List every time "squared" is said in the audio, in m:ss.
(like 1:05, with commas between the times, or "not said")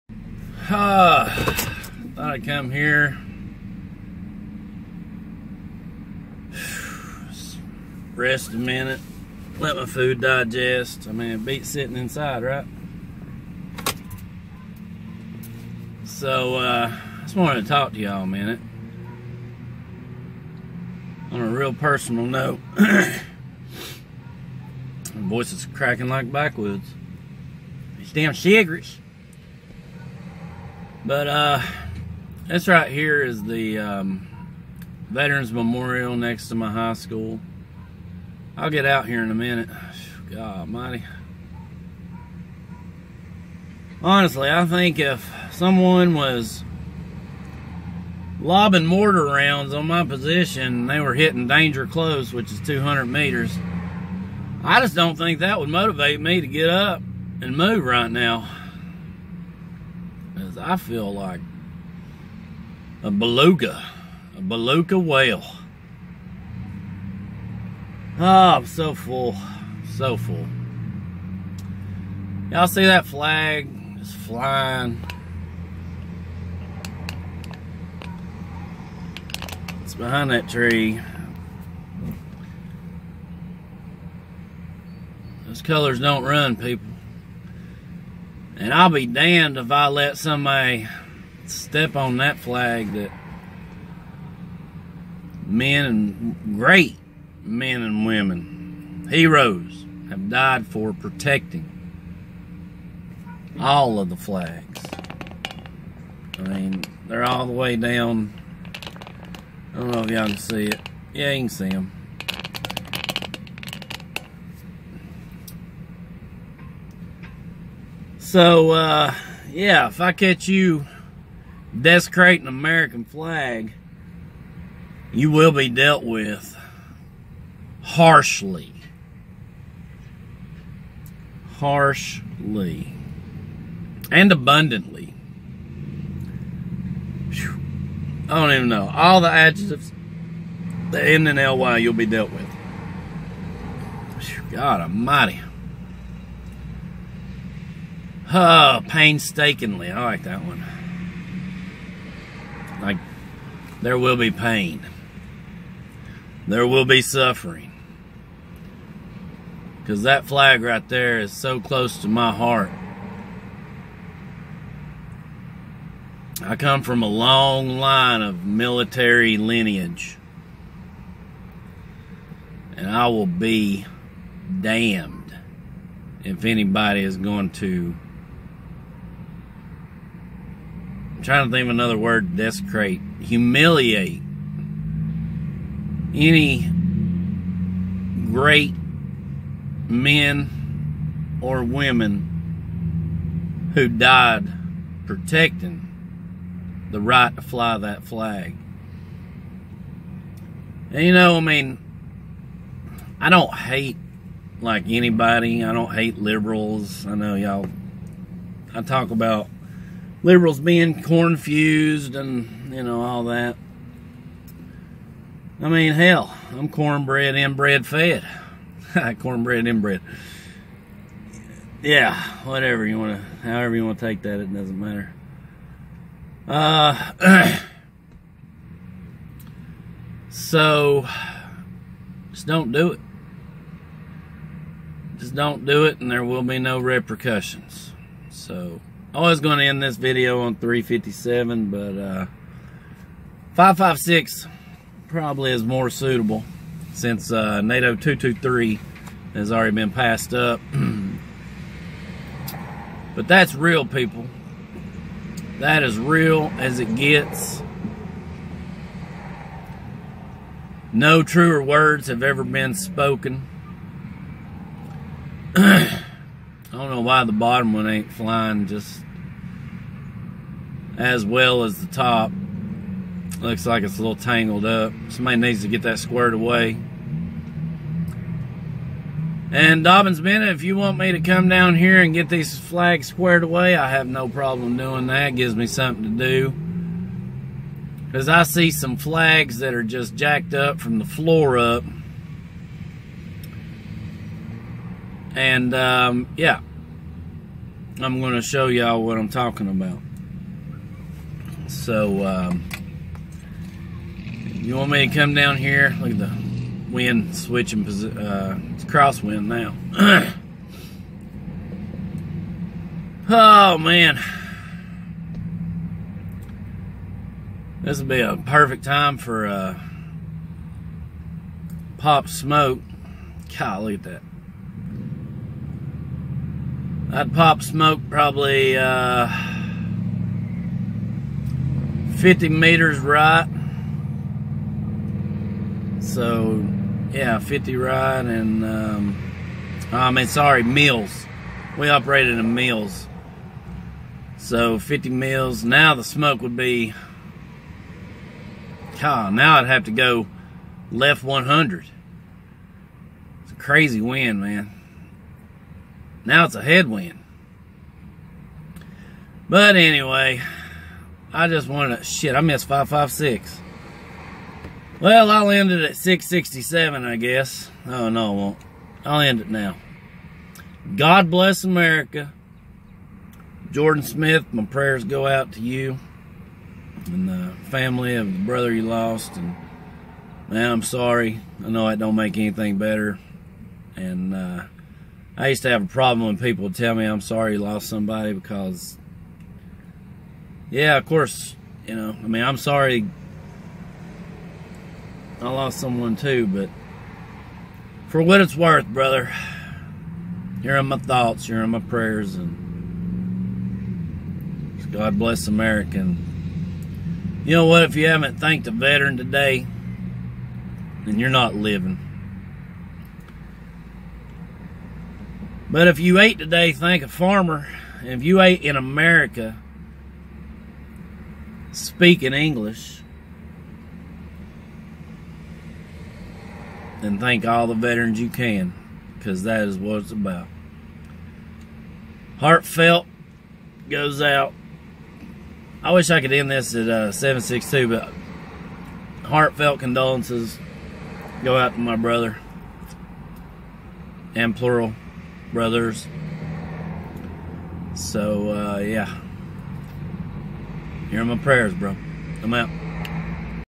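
4:35, 4:43.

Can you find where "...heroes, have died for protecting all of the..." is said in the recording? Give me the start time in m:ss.
1:39.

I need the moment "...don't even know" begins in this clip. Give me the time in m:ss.
2:18.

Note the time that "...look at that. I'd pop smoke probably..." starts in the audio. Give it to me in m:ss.
5:23.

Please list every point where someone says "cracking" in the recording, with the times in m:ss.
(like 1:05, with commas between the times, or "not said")
0:25.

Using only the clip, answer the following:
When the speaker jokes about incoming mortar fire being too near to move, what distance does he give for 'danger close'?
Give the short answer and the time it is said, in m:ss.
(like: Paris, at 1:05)
200 meters, at 0:52.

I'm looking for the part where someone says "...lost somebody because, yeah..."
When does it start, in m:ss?
6:27.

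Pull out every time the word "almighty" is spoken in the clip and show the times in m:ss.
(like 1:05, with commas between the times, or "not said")
0:40, 2:24.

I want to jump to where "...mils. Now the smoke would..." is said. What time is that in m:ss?
5:45.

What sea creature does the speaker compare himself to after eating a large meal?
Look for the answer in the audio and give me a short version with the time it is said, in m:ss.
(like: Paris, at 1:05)
Beluga whale, at 1:04.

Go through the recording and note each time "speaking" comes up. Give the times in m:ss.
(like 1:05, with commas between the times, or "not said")
7:01.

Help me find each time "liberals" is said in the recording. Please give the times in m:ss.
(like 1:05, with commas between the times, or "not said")
3:26, 3:30.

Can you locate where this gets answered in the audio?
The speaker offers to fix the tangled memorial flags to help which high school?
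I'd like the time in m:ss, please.
4:39.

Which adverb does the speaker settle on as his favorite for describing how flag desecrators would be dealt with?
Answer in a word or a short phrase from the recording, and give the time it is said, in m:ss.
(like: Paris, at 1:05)
Painstakingly, at 2:28.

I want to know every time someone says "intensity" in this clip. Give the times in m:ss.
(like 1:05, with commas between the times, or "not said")
not said.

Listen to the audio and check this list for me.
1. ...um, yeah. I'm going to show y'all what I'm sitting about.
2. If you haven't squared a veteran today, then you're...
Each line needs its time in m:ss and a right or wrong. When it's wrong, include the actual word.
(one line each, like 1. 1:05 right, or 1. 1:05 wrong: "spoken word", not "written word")
1. 4:55 wrong: "talking", not "sitting"
2. 6:47 wrong: "thanked", not "squared".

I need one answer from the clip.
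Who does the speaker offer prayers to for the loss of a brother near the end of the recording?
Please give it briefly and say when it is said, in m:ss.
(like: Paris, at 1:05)
Jordan Smith, at 6:13.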